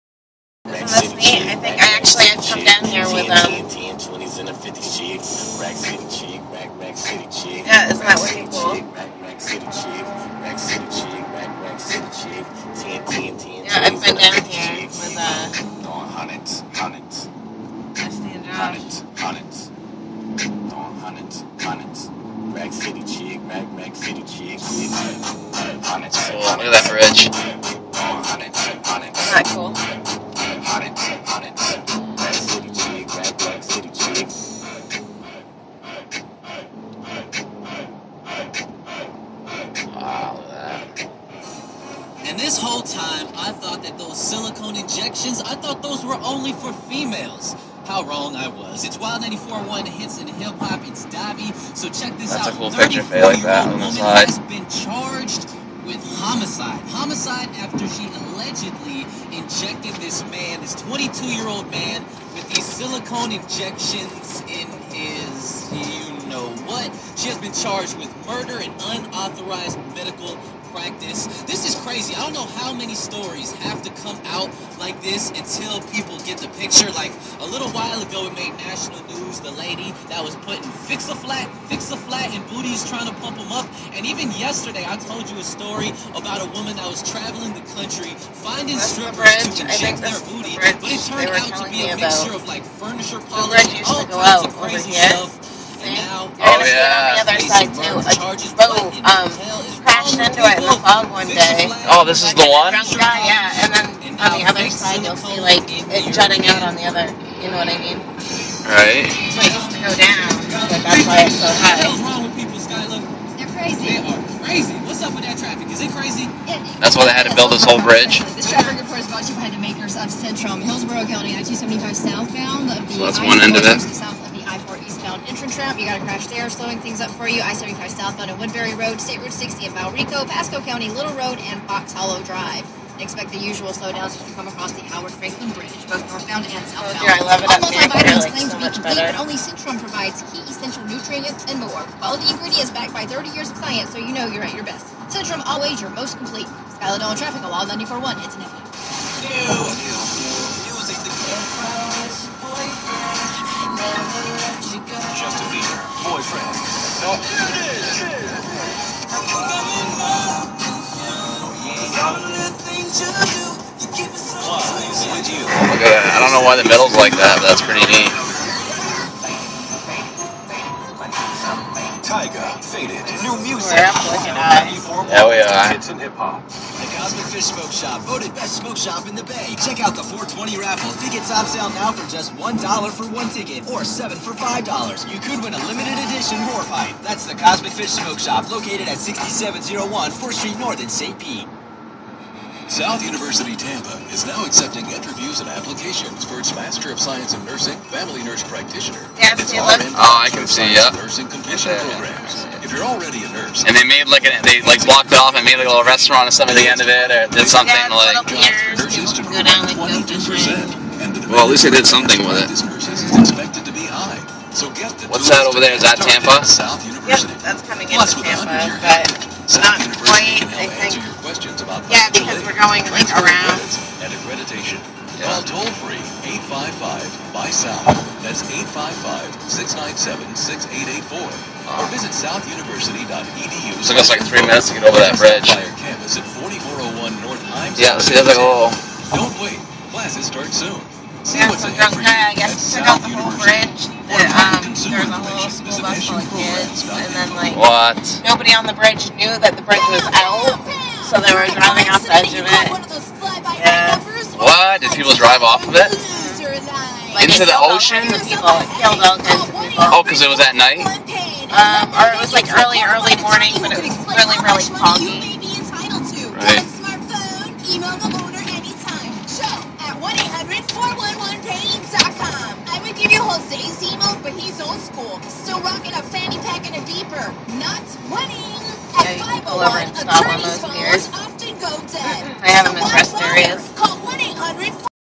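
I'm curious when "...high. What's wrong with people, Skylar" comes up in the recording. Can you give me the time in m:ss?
1:51.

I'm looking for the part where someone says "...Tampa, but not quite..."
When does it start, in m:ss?
3:38.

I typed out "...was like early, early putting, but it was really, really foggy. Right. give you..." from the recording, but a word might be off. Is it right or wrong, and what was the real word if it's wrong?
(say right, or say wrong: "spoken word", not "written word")
wrong: "morning", not "putting".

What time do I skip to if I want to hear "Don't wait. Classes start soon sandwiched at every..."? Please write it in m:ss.
3:59.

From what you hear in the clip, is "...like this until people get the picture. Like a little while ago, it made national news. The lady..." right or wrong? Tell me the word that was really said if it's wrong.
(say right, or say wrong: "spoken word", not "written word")
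right.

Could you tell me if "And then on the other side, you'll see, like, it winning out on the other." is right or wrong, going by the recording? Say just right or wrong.
wrong.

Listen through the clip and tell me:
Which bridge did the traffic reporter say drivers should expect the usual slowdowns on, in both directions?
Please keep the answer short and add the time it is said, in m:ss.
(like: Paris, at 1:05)
Howard Franklin Bridge, at 2:14.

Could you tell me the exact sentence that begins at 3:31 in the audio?
Well, at least they did something with it.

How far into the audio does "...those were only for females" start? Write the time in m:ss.
0:45.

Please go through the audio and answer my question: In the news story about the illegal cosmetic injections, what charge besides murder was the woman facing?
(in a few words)
Unauthorized medical practice.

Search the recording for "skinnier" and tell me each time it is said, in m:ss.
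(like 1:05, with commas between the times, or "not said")
not said.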